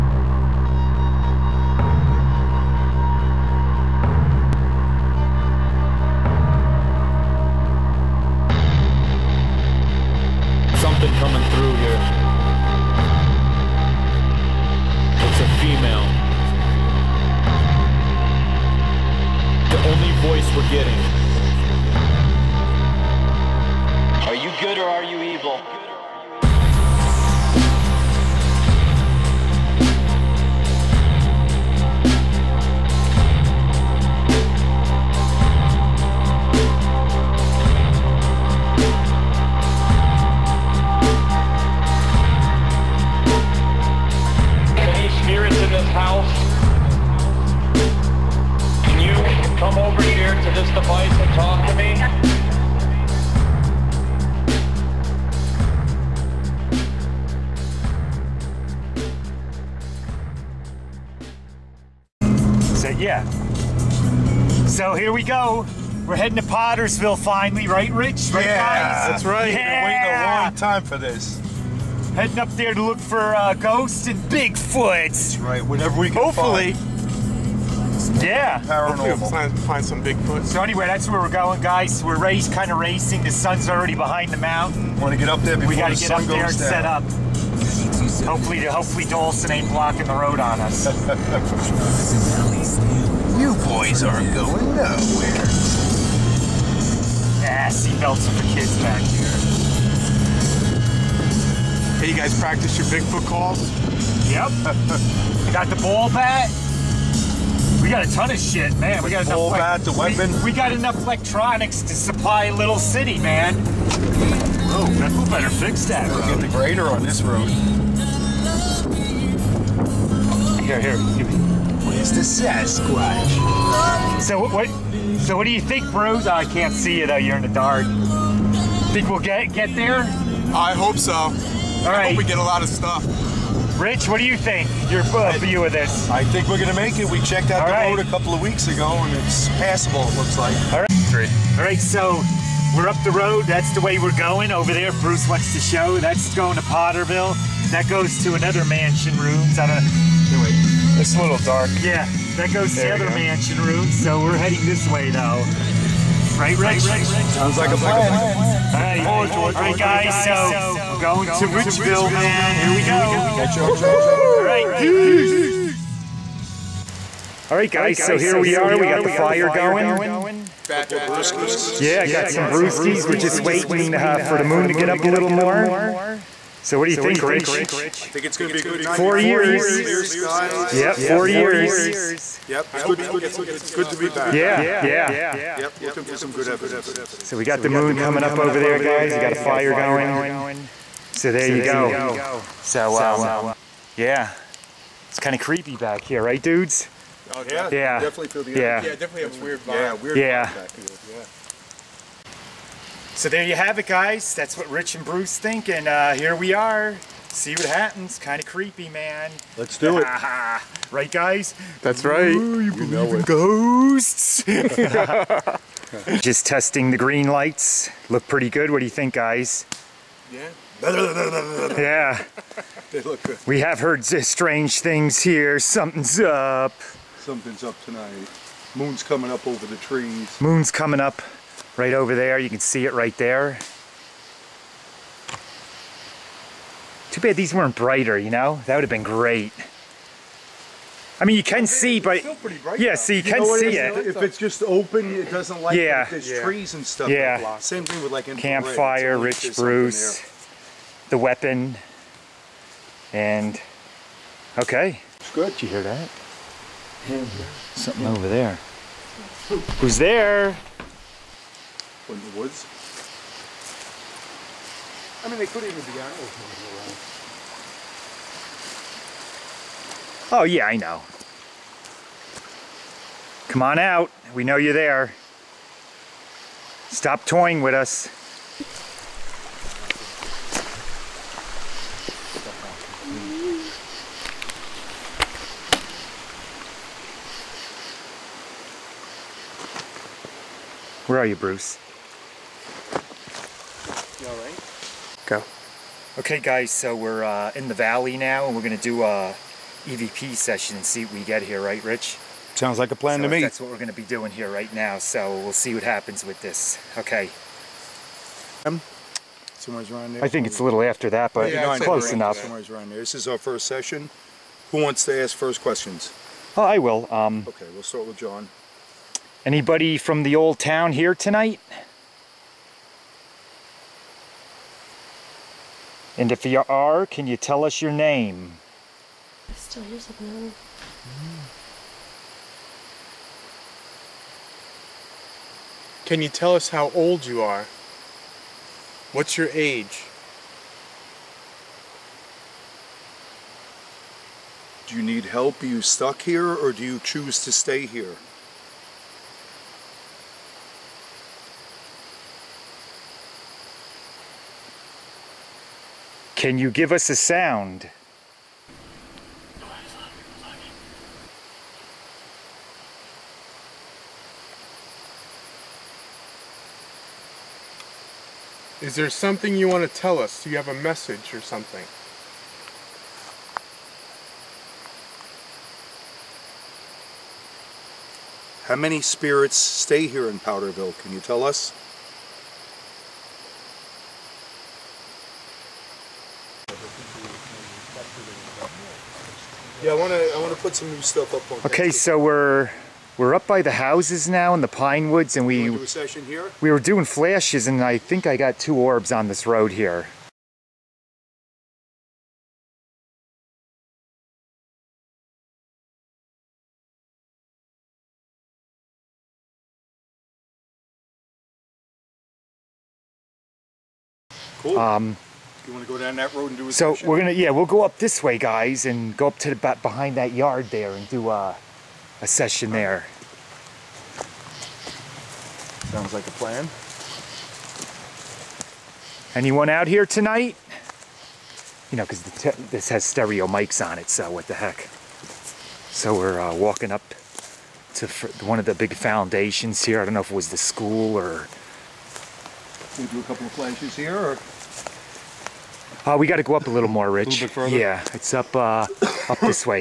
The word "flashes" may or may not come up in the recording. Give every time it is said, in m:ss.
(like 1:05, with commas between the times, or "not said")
6:37, 7:23.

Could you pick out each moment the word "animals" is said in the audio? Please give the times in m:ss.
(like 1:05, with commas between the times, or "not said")
4:25.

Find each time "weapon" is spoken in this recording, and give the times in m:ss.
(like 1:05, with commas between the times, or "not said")
1:49, 4:11.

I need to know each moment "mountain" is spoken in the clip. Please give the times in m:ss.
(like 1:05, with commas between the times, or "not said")
1:24.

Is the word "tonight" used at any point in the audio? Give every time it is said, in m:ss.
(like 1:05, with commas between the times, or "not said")
3:47, 5:21, 7:10.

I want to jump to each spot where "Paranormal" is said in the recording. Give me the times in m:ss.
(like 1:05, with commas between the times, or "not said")
1:18.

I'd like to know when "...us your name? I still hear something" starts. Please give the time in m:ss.
5:27.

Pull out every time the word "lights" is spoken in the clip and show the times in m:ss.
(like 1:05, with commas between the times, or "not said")
3:37, 4:05.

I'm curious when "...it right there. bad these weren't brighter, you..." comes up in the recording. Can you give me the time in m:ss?
3:52.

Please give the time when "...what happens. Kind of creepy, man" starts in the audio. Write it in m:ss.
3:27.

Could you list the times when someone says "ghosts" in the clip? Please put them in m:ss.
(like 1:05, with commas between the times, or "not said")
1:13, 3:33.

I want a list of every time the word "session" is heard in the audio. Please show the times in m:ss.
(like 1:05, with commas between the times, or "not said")
5:00, 5:13, 7:02.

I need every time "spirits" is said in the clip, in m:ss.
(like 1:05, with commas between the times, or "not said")
6:18.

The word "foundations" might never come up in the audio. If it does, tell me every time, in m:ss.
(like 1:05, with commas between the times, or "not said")
7:18.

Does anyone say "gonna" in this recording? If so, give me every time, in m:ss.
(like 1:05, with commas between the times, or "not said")
2:16, 6:57.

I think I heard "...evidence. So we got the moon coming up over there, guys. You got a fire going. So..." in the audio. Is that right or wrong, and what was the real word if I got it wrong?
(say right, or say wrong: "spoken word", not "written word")
right.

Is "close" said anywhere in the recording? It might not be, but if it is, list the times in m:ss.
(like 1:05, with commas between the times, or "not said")
5:11.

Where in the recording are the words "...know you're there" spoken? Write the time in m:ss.
4:34.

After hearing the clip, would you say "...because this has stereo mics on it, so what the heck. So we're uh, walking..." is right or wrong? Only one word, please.
right.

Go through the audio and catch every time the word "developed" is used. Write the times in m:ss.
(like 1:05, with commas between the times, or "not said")
not said.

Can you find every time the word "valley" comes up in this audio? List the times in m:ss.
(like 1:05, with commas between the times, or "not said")
4:57.